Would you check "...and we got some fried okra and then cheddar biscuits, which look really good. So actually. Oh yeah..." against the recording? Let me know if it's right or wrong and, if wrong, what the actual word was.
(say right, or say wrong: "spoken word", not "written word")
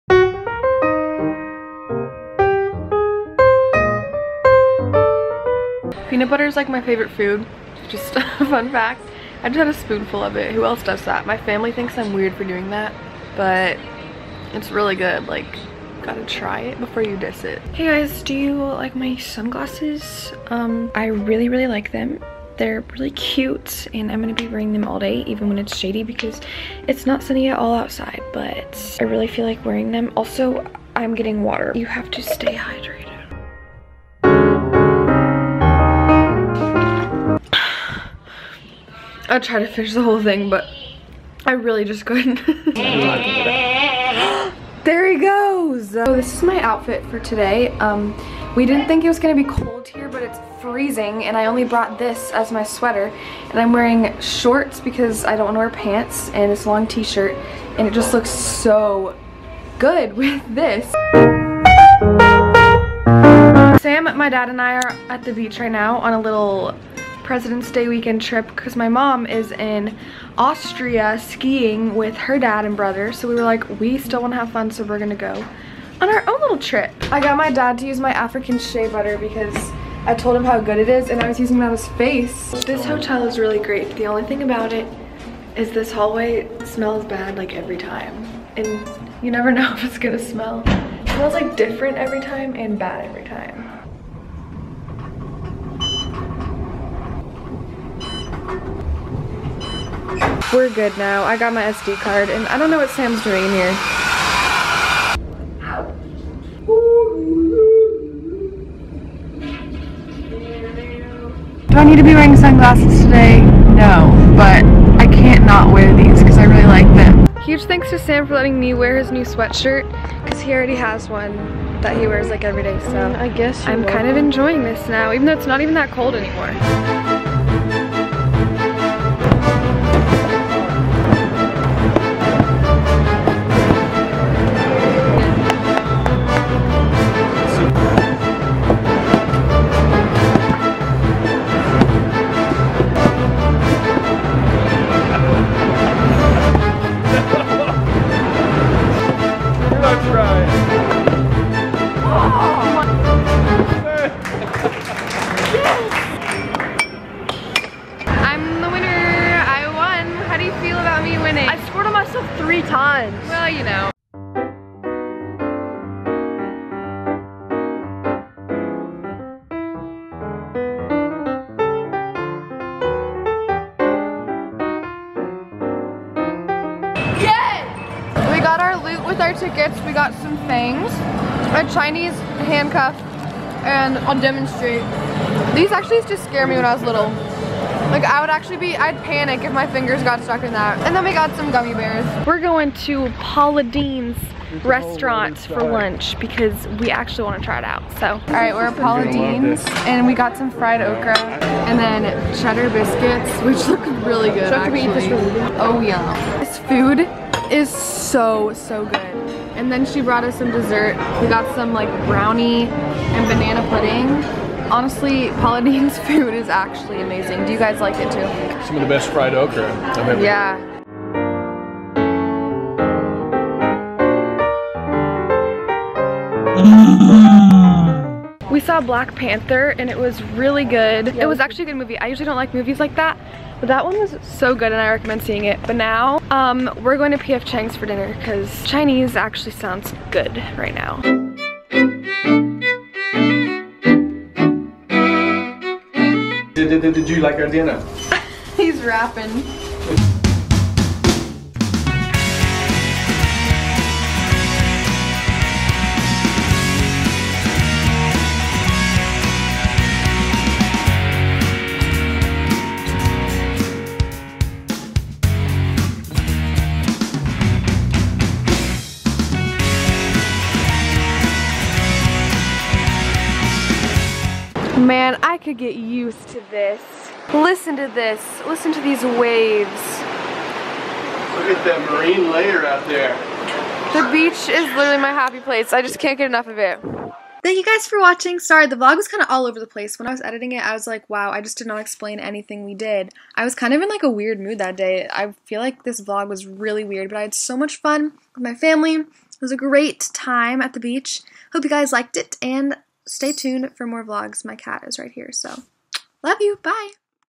right.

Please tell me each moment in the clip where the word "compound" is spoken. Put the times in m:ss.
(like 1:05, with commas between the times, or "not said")
not said.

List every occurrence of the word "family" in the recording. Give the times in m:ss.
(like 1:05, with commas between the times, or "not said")
0:11, 4:58.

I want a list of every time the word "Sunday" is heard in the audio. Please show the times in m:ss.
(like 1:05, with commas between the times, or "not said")
not said.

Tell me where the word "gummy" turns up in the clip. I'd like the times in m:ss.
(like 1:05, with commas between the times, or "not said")
3:11.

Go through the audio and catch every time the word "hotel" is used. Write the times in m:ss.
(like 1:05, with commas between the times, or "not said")
1:22.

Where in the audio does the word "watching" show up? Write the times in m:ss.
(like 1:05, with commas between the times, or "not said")
4:47.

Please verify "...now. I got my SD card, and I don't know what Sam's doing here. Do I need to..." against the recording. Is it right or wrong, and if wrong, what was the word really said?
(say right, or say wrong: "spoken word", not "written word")
right.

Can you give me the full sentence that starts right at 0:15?
Like, gotta try it before you diss it.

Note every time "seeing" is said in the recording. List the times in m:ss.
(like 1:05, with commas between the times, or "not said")
3:55.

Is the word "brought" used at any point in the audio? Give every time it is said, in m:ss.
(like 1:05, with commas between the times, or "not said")
0:51, 3:30.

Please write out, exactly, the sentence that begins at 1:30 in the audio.
It smells like different every time and bad every time.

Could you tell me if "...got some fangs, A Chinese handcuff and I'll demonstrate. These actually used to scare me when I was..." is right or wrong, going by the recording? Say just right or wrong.
right.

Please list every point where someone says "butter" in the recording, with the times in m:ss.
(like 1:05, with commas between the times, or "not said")
0:06, 1:18.